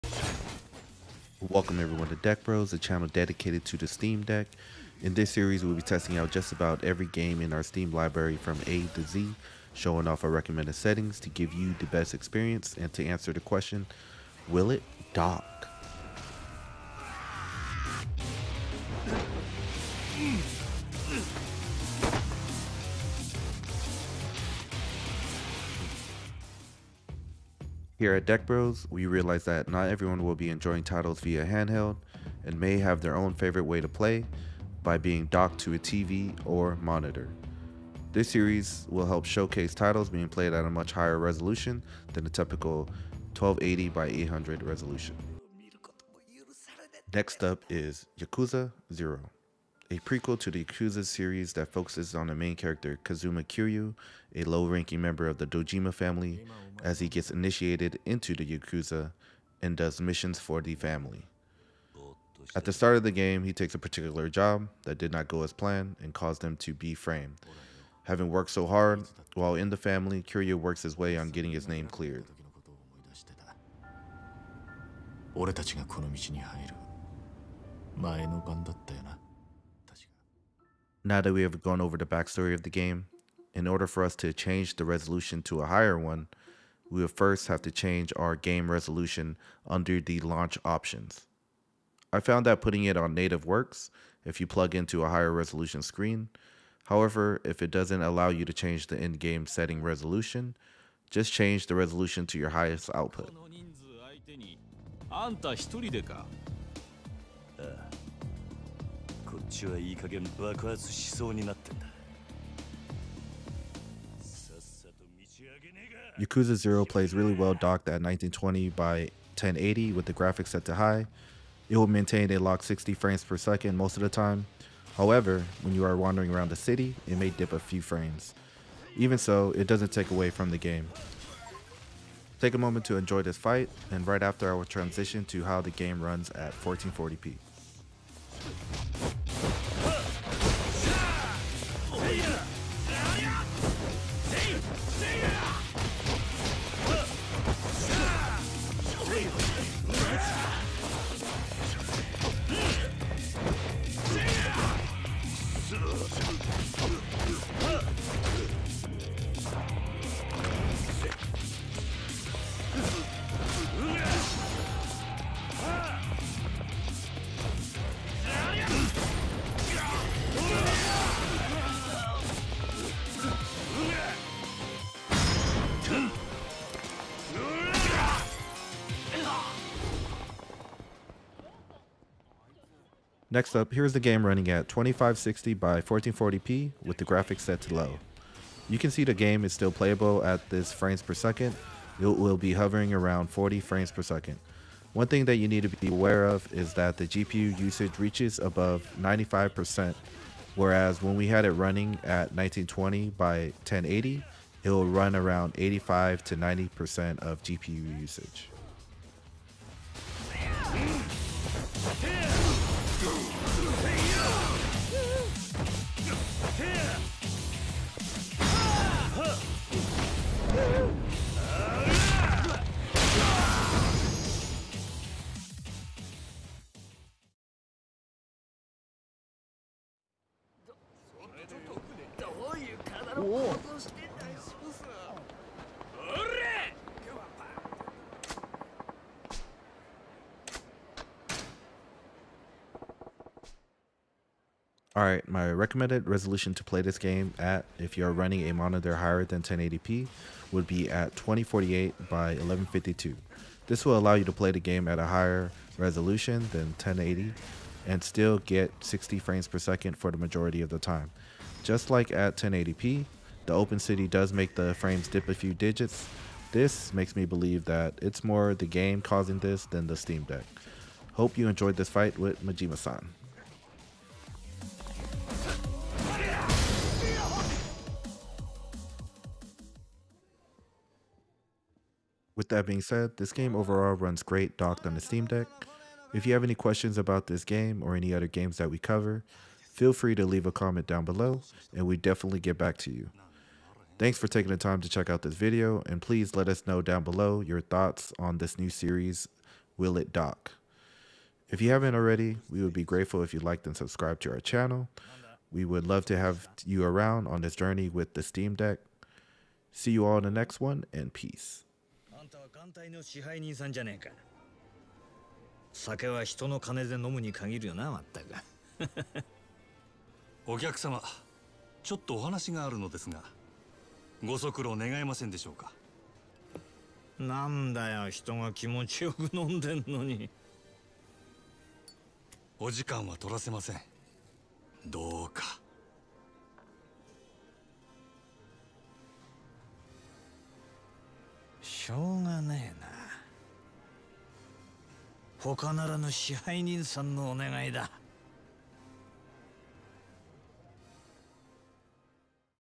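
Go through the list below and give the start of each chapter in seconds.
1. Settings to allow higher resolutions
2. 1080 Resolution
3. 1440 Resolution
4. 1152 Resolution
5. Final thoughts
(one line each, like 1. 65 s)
1. 83 s
2. 104 s
3. 180 s
4. 234 s
5. 280 s.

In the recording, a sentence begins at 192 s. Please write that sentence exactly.
It will be hovering around 40 frames per second.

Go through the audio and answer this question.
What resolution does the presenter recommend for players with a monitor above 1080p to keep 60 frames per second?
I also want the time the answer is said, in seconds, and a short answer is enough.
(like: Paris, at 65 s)
2048 by 1152, at 251 s.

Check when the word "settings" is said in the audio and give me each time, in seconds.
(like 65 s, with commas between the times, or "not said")
10 s, 99 s.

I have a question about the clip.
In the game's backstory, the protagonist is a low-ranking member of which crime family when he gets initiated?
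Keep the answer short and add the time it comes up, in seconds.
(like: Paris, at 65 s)
Dojima family, at 55 s.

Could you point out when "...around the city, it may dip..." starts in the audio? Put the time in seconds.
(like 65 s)
126 s.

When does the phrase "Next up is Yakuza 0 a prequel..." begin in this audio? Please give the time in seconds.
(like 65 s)
47 s.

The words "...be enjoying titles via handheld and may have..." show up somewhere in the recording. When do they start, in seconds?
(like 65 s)
30 s.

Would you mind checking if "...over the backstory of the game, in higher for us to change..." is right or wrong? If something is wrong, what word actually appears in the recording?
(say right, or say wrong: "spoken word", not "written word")
wrong: "order", not "higher".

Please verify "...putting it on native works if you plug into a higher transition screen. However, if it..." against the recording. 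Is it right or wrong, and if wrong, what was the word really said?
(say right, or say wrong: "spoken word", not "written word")
wrong: "resolution", not "transition".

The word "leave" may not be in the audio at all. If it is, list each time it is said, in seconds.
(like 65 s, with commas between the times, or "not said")
290 s.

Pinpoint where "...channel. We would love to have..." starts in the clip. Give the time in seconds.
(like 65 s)
304 s.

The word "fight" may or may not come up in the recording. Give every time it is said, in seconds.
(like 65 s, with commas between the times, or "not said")
133 s, 271 s.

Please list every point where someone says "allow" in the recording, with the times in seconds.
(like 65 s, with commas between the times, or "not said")
98 s, 253 s.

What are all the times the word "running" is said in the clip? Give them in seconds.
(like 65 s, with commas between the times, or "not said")
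184 s, 201 s, 248 s.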